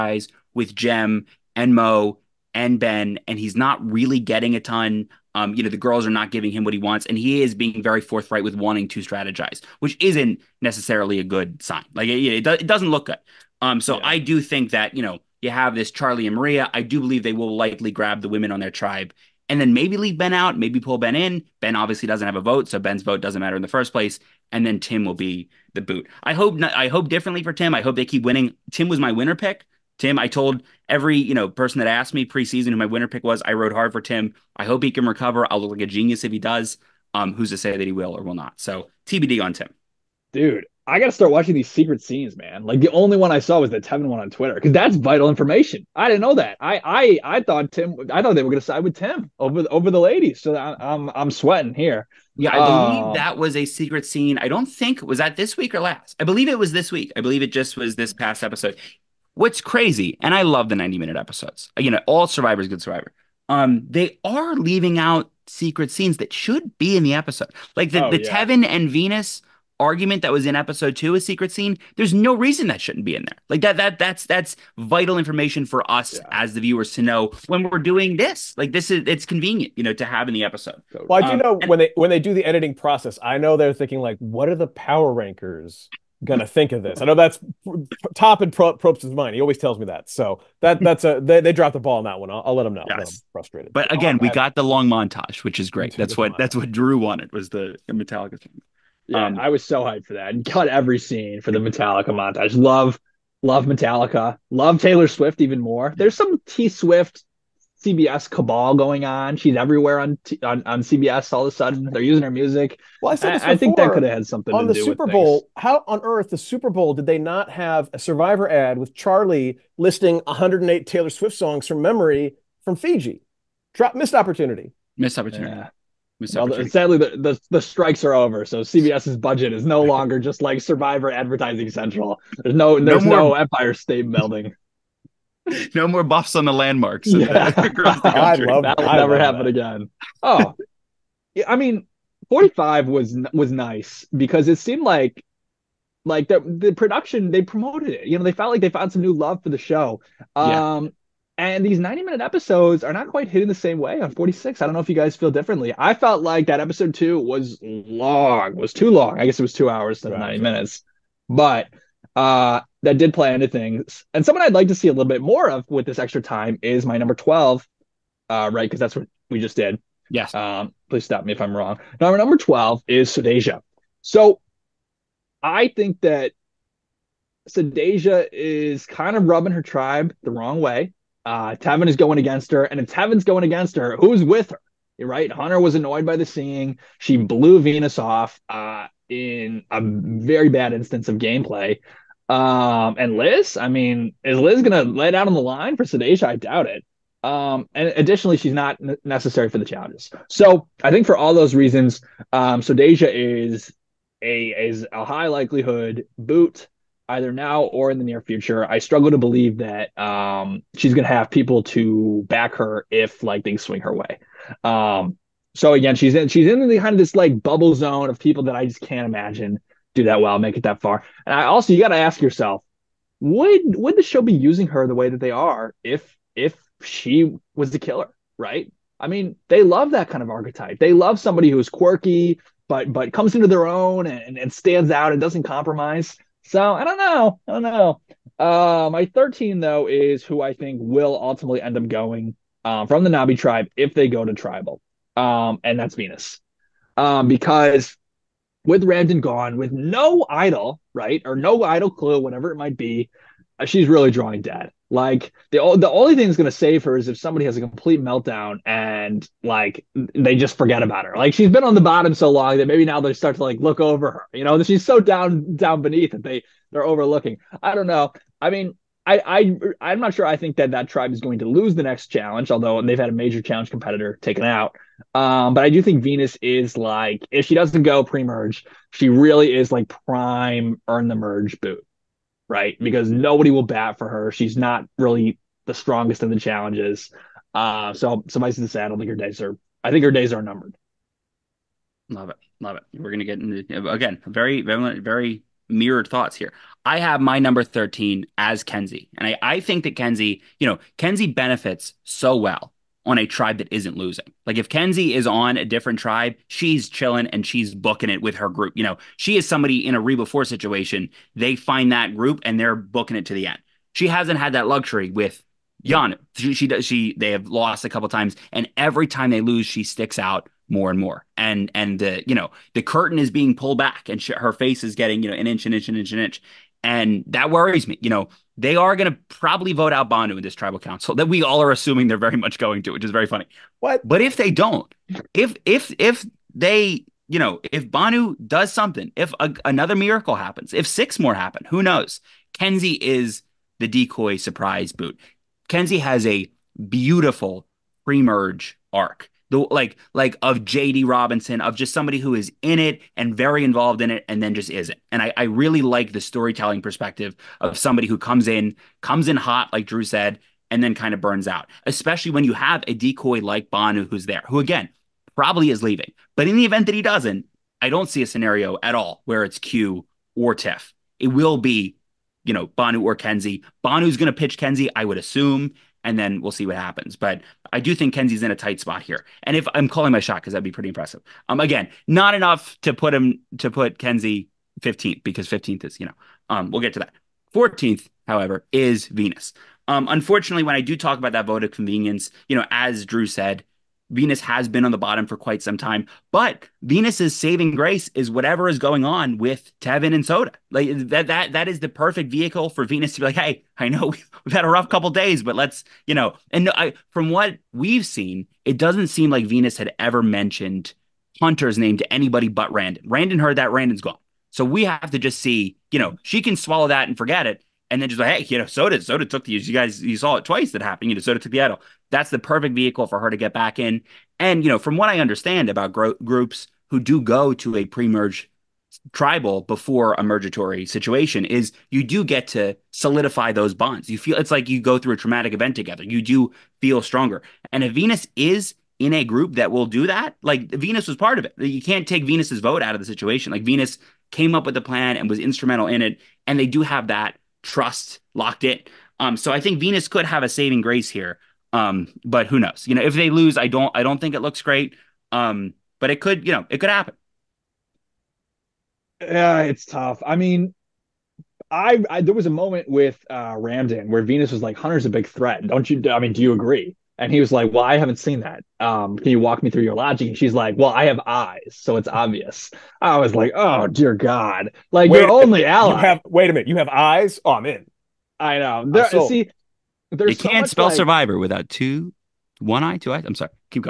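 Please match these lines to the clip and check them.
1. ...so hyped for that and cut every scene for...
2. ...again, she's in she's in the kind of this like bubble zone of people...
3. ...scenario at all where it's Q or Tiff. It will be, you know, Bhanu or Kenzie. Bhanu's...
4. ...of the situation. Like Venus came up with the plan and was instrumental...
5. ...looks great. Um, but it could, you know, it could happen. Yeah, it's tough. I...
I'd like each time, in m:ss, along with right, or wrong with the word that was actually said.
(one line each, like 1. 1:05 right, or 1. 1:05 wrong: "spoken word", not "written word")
1. 1:39 right
2. 3:35 right
3. 6:08 right
4. 7:22 right
5. 7:34 right.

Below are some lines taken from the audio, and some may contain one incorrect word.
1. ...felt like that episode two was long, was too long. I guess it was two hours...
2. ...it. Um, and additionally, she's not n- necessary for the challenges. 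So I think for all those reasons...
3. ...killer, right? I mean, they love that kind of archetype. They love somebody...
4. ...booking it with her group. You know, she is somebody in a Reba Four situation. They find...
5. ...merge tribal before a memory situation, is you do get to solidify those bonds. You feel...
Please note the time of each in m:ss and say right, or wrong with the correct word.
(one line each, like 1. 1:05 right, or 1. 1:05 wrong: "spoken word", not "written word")
1. 2:35 right
2. 3:16 right
3. 3:47 right
4. 5:07 right
5. 7:08 wrong: "mergatory", not "memory".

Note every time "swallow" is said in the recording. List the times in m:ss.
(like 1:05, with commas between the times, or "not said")
6:56.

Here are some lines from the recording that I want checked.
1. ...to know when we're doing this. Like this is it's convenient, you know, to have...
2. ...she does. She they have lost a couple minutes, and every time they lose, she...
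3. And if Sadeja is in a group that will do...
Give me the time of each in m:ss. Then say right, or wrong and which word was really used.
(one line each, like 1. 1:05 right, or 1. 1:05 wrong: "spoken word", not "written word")
1. 1:16 right
2. 5:16 wrong: "times", not "minutes"
3. 7:17 wrong: "Venus", not "Sadeja".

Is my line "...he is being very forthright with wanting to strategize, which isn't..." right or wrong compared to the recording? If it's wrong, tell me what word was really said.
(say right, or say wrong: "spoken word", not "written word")
right.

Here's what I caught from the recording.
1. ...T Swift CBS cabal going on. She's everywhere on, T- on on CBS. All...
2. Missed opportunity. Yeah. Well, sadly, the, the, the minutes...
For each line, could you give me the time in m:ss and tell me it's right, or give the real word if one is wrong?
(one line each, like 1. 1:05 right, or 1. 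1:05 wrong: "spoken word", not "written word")
1. 1:46 right
2. 2:04 wrong: "strikes", not "minutes".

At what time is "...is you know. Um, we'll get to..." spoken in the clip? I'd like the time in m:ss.
6:25.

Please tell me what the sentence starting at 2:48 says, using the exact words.
Because that's what we just did.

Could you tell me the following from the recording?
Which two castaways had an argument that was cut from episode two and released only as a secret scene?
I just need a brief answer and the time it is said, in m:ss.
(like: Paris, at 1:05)
Tevin and Venus, at 1:08.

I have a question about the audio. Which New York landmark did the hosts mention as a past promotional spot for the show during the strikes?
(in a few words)
Empire State Building.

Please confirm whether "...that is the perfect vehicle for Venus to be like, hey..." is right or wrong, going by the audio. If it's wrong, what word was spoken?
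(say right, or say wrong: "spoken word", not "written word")
right.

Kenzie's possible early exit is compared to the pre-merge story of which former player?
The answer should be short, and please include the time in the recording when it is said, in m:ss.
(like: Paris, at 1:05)
JD Robinson, at 5:50.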